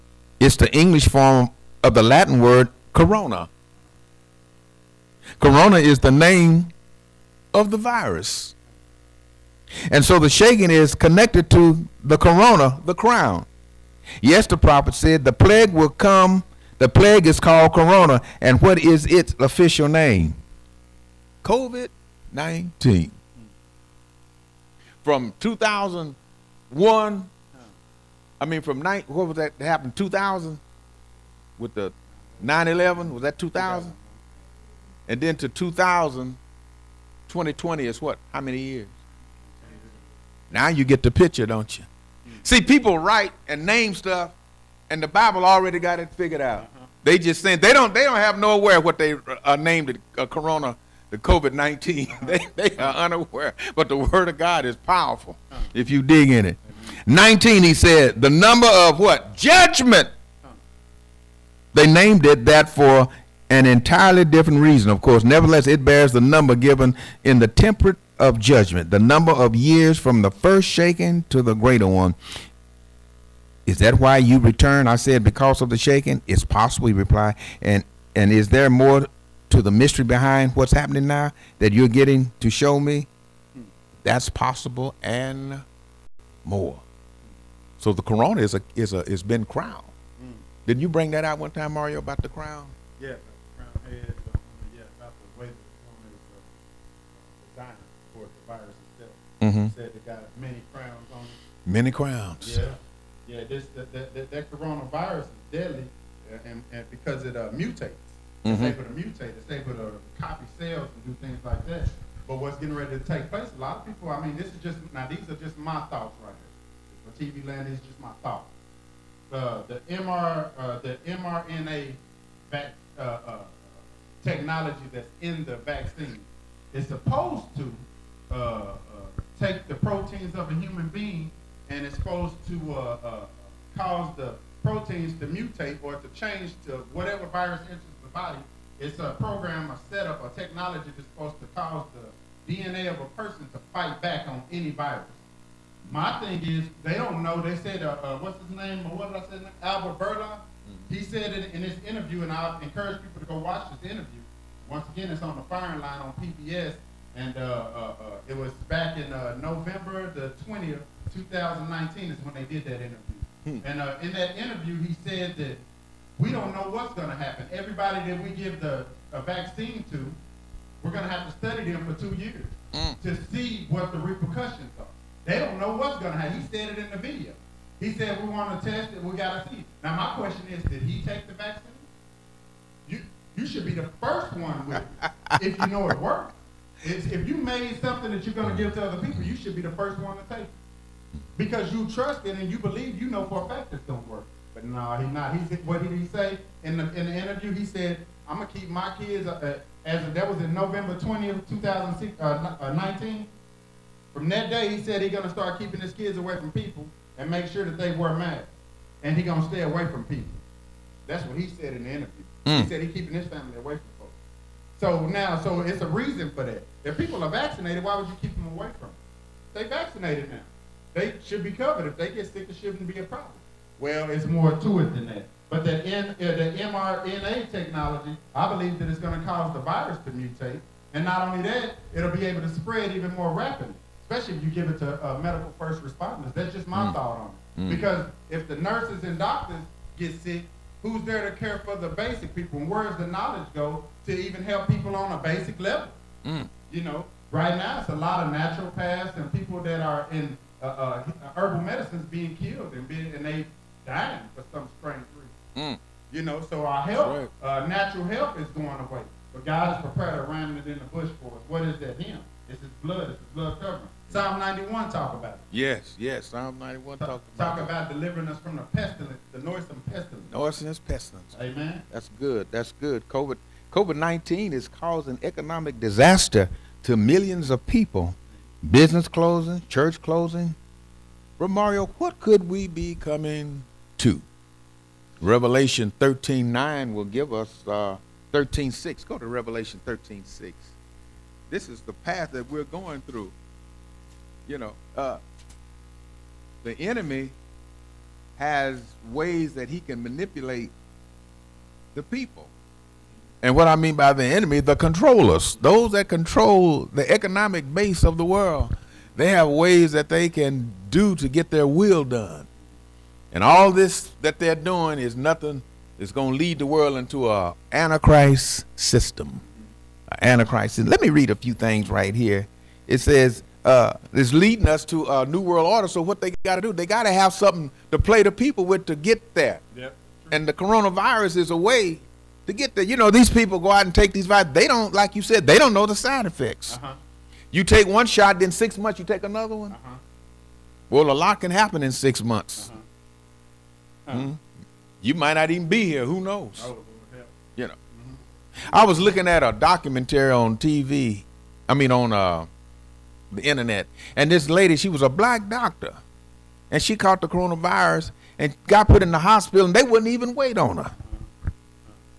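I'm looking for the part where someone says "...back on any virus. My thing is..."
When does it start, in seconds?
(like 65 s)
144 s.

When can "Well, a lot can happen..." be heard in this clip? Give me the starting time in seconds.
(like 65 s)
340 s.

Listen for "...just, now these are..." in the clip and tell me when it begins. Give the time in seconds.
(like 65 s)
114 s.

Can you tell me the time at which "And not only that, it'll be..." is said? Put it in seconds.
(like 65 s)
230 s.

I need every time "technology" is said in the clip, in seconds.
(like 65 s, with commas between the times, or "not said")
124 s, 140 s, 227 s.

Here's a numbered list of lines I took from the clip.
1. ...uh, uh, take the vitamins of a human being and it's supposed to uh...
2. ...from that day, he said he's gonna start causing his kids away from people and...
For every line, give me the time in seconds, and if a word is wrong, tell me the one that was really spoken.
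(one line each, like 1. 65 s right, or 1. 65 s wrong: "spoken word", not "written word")
1. 128 s wrong: "proteins", not "vitamins"
2. 204 s wrong: "keeping", not "causing".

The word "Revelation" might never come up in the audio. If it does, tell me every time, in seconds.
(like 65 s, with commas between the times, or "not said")
285 s, 289 s.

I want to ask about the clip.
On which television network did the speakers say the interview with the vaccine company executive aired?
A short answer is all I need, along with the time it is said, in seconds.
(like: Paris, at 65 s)
PBS, at 156 s.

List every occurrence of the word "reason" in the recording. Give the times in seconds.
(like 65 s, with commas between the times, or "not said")
64 s, 215 s, 255 s.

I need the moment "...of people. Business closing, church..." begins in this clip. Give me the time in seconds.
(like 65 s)
277 s.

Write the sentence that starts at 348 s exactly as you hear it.
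I was looking at a documentary on TV.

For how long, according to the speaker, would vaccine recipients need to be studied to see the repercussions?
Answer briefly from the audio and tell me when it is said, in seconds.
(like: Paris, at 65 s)
2 years, at 172 s.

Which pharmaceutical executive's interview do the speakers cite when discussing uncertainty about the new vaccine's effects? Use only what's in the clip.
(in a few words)
Albert Bourla.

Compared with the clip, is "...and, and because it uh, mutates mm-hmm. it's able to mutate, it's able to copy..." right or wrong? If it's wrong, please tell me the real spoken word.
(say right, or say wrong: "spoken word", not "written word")
right.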